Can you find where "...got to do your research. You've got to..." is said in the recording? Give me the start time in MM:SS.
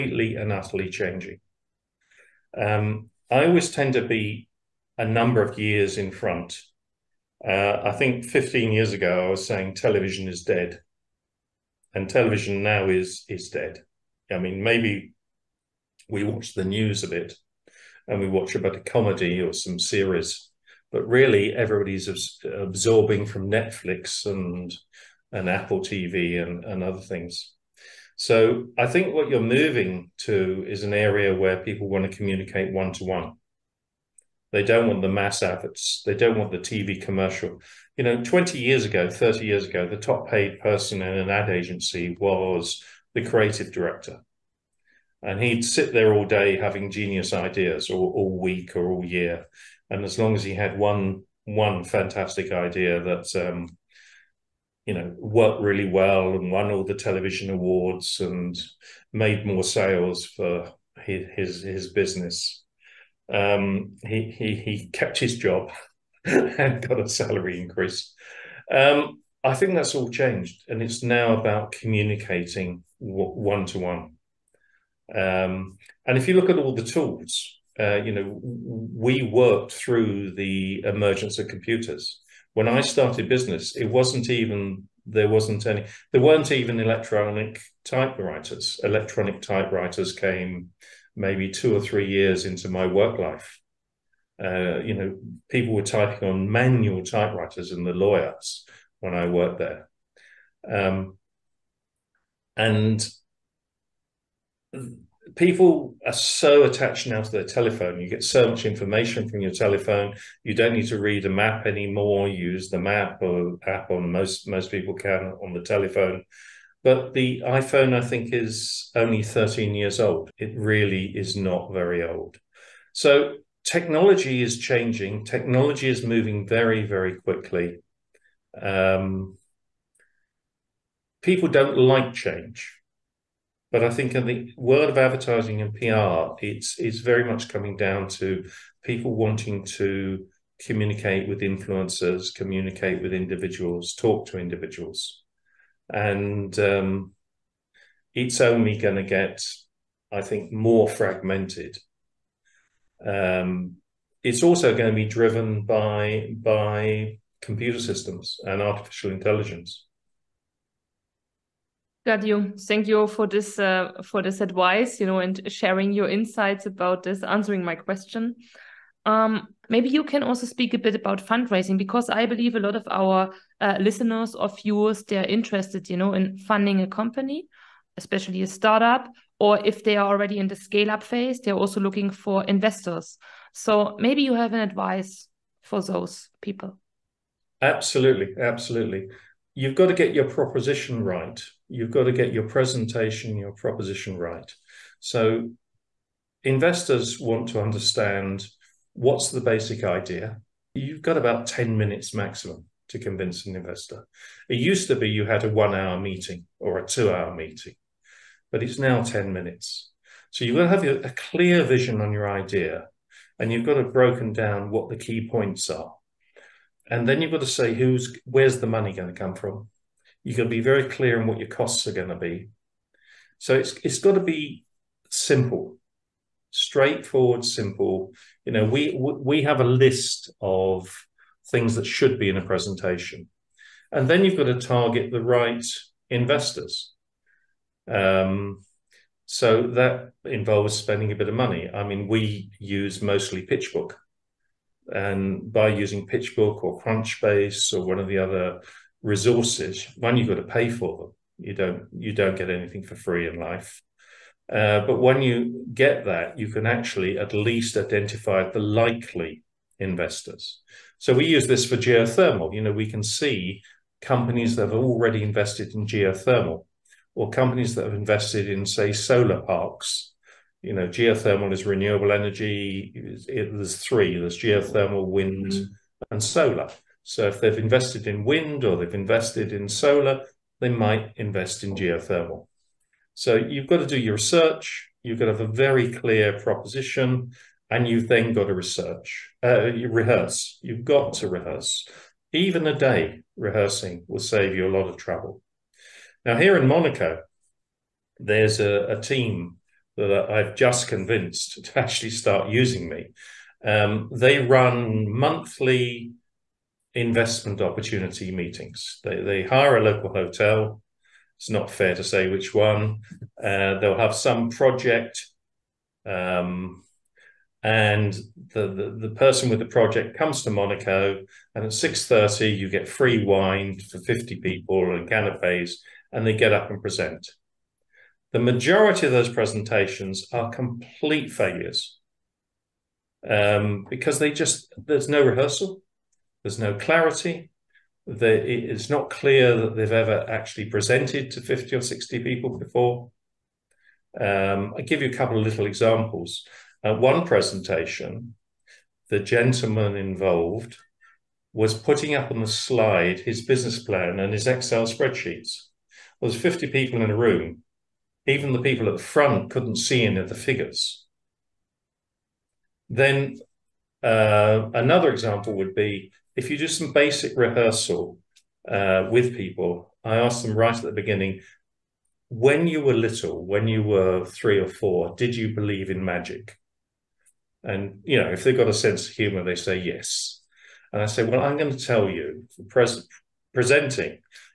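04:43.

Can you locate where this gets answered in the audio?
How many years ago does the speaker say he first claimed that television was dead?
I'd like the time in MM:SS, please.
00:08.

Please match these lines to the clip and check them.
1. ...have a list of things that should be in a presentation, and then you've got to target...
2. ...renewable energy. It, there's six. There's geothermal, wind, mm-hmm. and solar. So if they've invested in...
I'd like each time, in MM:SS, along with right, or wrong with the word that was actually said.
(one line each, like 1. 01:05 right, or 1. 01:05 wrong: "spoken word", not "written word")
1. 03:49 right
2. 04:31 wrong: "three", not "six".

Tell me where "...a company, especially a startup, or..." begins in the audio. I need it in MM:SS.
02:56.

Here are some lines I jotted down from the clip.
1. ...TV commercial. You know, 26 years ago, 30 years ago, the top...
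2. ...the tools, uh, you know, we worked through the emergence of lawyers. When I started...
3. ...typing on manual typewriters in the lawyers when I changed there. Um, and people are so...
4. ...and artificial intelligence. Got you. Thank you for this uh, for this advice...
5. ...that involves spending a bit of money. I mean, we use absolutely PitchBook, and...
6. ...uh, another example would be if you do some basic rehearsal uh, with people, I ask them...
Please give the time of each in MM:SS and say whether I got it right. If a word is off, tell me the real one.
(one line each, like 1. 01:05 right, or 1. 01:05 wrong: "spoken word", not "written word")
1. 00:36 wrong: "20", not "26"
2. 01:16 wrong: "computers", not "lawyers"
3. 01:35 wrong: "worked", not "changed"
4. 02:38 right
5. 03:59 wrong: "mostly", not "absolutely"
6. 06:04 right.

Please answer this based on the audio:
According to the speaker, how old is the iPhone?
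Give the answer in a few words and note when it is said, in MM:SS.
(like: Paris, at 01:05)
13 years, at 01:59.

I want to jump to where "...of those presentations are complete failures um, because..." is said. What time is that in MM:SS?
05:29.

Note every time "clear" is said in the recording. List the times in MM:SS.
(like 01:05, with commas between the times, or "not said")
03:31, 03:40, 04:45, 05:39.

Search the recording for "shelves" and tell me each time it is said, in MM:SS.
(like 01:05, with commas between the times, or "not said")
not said.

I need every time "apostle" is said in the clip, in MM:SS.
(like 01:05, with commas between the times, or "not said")
not said.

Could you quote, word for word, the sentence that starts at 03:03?
So maybe you have an advice for those people.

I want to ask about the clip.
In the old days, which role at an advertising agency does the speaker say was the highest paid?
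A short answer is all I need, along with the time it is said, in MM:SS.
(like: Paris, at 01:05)
creative director, at 00:43.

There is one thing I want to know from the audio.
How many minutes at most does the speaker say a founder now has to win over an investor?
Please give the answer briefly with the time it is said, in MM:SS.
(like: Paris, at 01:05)
10 minutes, at 03:21.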